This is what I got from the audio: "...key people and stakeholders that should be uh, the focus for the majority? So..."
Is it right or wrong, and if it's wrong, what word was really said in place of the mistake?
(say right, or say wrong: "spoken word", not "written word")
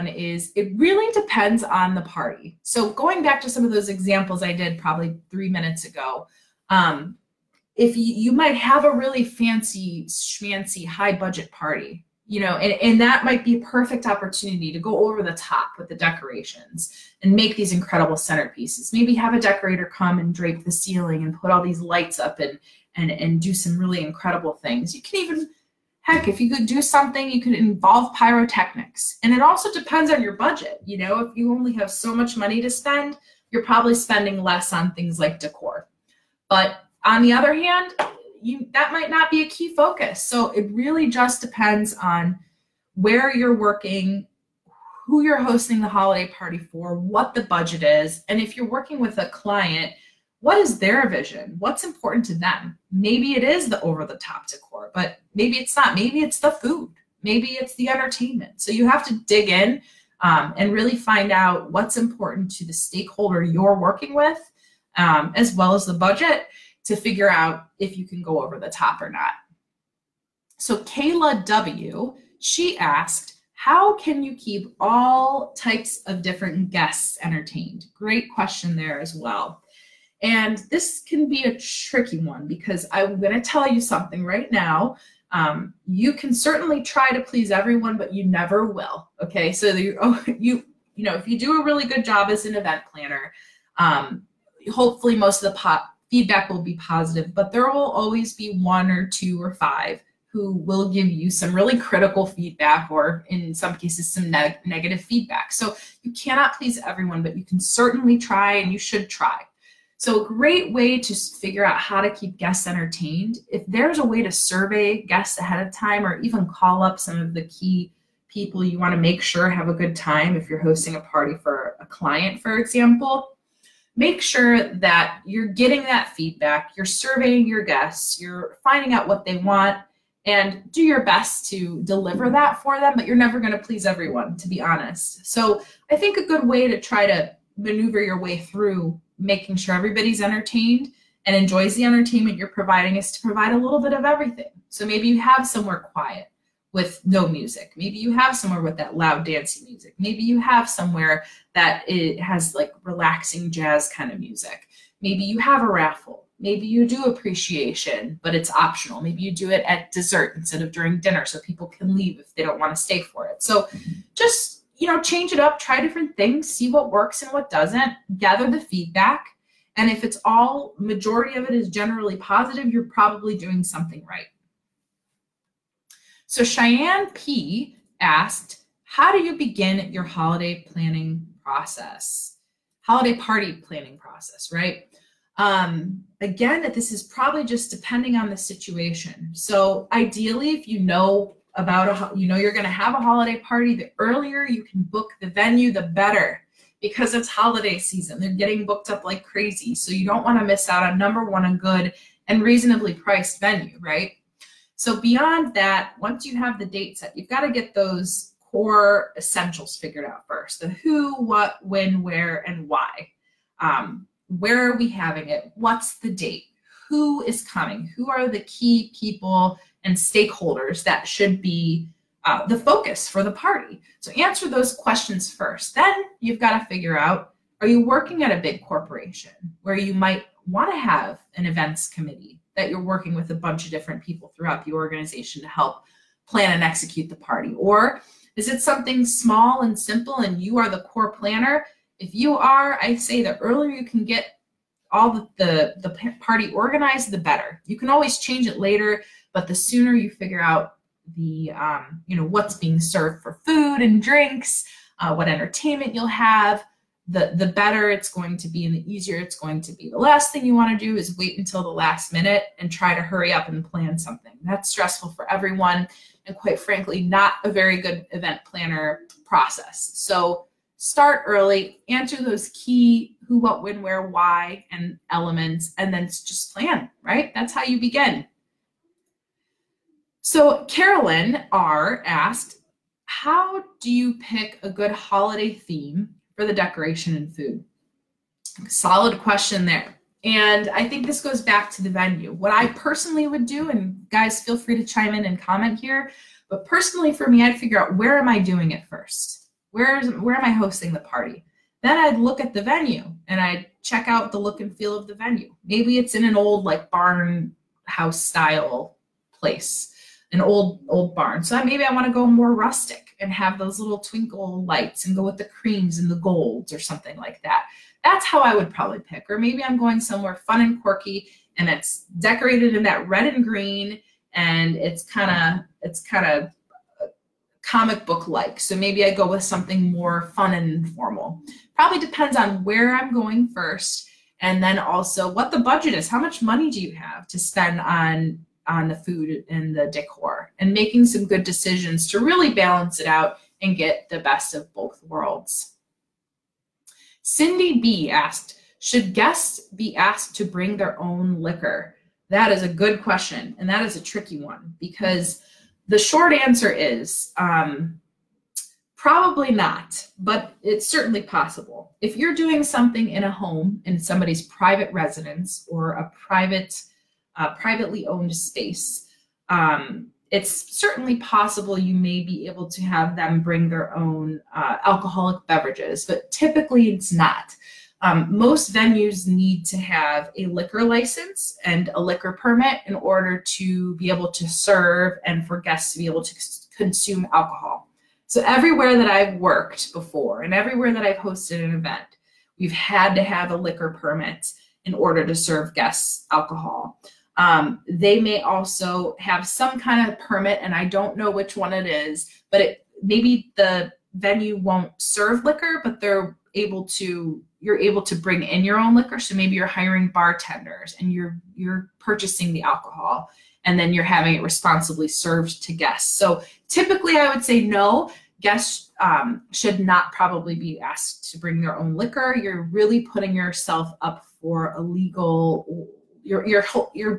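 wrong: "party", not "majority".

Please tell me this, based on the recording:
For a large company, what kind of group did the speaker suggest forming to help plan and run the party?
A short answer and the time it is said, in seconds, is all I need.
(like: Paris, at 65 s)
events committee, at 231 s.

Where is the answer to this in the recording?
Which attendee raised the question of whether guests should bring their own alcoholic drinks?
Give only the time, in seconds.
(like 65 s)
347 s.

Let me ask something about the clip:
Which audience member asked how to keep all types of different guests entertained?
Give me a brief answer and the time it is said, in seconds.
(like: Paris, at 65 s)
Kayla W, at 70 s.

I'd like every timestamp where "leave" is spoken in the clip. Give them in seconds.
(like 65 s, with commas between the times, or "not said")
161 s.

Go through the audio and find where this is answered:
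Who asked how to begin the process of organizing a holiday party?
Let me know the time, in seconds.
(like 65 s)
176 s.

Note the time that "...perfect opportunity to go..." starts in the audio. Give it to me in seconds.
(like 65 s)
13 s.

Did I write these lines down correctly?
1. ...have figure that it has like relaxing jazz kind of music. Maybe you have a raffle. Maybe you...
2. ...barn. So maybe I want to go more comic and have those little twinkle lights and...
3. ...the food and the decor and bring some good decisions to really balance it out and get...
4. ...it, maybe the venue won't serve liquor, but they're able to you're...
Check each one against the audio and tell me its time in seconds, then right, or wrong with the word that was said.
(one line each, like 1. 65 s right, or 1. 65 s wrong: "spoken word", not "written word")
1. 150 s wrong: "somewhere", not "figure"
2. 311 s wrong: "rustic", not "comic"
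3. 338 s wrong: "making", not "bring"
4. 402 s right.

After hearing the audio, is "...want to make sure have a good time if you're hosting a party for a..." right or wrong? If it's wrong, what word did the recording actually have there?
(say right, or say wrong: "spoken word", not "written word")
right.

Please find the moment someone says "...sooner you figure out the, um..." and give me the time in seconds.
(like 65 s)
249 s.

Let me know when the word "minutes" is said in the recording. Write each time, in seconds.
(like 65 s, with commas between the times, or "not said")
5 s, 262 s.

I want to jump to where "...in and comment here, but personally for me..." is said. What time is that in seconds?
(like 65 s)
295 s.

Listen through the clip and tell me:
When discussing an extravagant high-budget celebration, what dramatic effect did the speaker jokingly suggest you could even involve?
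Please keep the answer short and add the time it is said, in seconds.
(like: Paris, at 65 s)
pyrotechnics, at 28 s.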